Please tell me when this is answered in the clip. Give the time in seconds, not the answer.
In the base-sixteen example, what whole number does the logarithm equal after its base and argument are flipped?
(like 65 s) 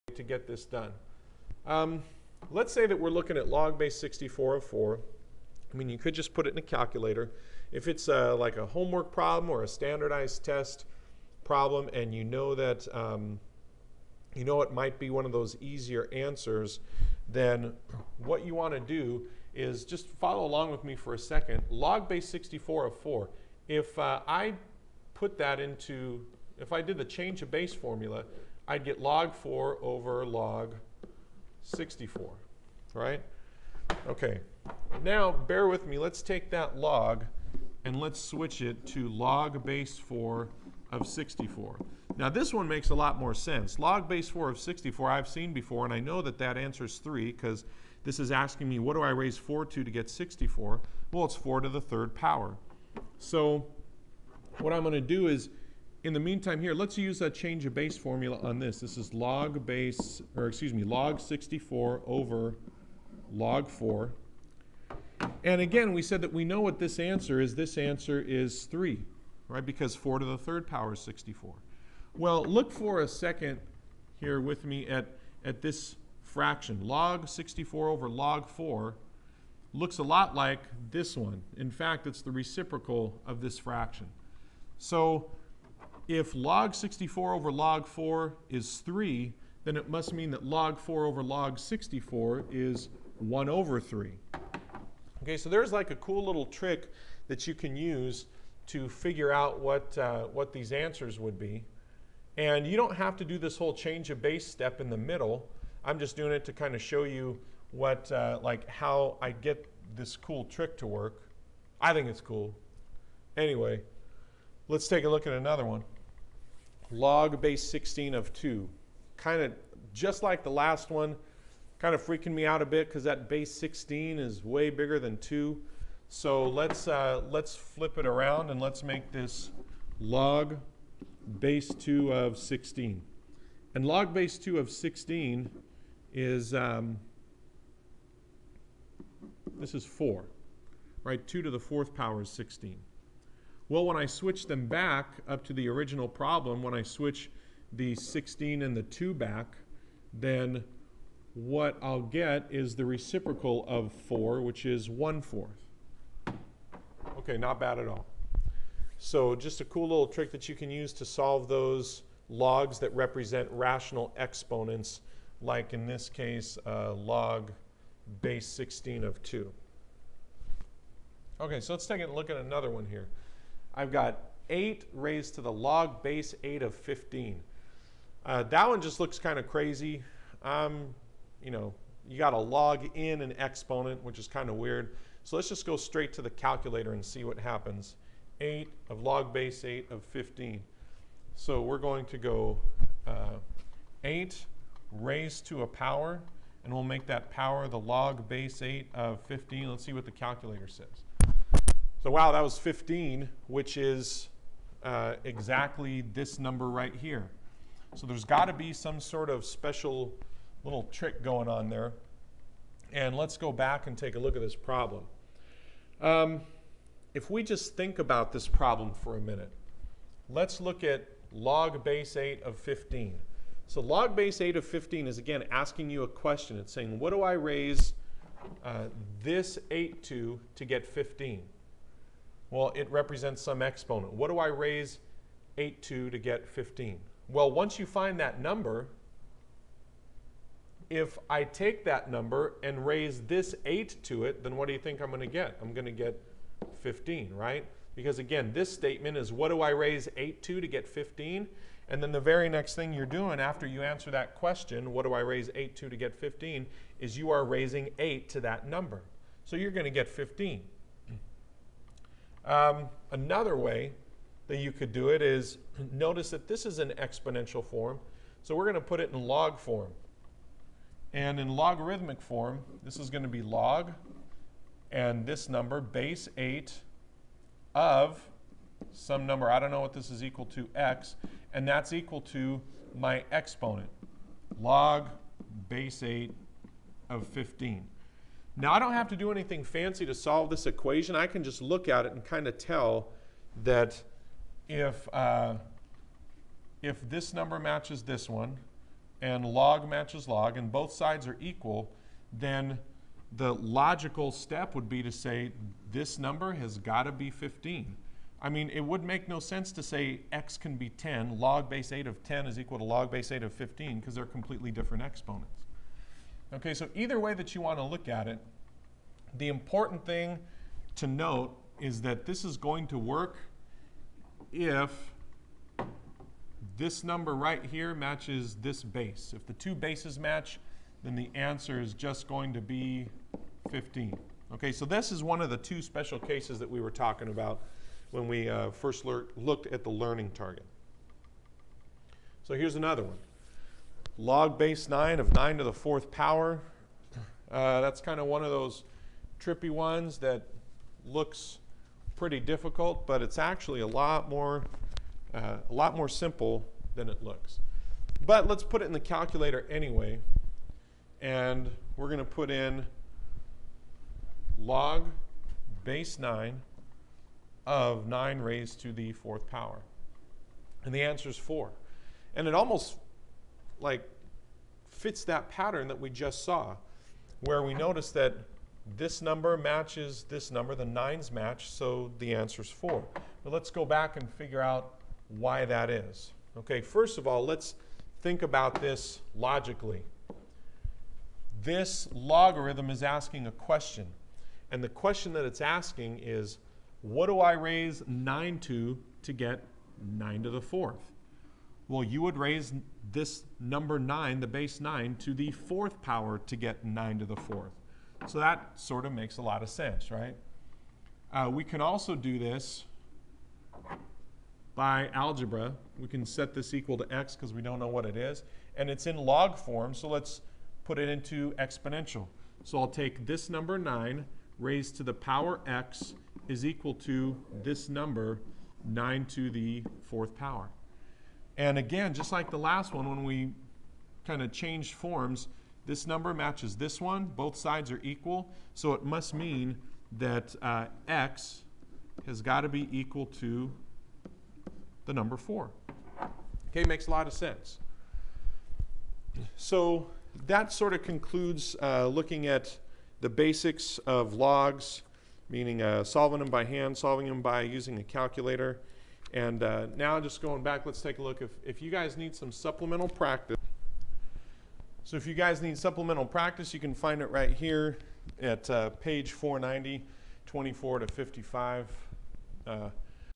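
139 s.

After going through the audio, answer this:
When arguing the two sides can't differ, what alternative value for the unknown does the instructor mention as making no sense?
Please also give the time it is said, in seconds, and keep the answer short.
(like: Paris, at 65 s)
10, at 310 s.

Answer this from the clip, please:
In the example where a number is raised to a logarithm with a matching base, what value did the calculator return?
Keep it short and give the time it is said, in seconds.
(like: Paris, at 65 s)
15, at 202 s.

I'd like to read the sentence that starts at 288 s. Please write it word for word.
Now I don't have to do anything fancy to solve this equation.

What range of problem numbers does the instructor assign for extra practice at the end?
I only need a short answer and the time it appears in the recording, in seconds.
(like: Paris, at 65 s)
24 to 55, at 470 s.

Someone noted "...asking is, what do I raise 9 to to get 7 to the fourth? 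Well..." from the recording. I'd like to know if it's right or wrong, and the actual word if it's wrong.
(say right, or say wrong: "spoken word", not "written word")
wrong: "9", not "7".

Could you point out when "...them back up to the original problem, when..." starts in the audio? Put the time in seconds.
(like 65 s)
144 s.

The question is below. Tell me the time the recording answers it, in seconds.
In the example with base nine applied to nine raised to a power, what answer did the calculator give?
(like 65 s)
370 s.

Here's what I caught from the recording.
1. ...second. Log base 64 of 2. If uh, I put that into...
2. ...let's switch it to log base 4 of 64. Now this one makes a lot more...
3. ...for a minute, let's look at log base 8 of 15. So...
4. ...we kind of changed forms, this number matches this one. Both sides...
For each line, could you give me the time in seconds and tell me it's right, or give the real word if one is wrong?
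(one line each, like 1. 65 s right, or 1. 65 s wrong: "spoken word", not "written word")
1. 21 s wrong: "4", not "2"
2. 37 s right
3. 218 s right
4. 433 s right.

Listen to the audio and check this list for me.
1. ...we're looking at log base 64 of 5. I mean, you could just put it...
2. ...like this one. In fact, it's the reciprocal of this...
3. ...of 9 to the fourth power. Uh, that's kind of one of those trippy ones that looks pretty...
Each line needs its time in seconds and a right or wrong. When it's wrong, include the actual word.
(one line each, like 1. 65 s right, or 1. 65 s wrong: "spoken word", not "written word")
1. 2 s wrong: "4", not "5"
2. 80 s right
3. 345 s right.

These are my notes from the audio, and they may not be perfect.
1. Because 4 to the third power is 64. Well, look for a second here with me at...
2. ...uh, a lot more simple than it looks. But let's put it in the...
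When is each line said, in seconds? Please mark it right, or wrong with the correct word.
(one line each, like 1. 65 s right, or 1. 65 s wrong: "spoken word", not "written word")
1. 69 s right
2. 355 s right.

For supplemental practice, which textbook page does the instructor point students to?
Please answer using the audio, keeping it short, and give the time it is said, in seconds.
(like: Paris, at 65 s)
490, at 468 s.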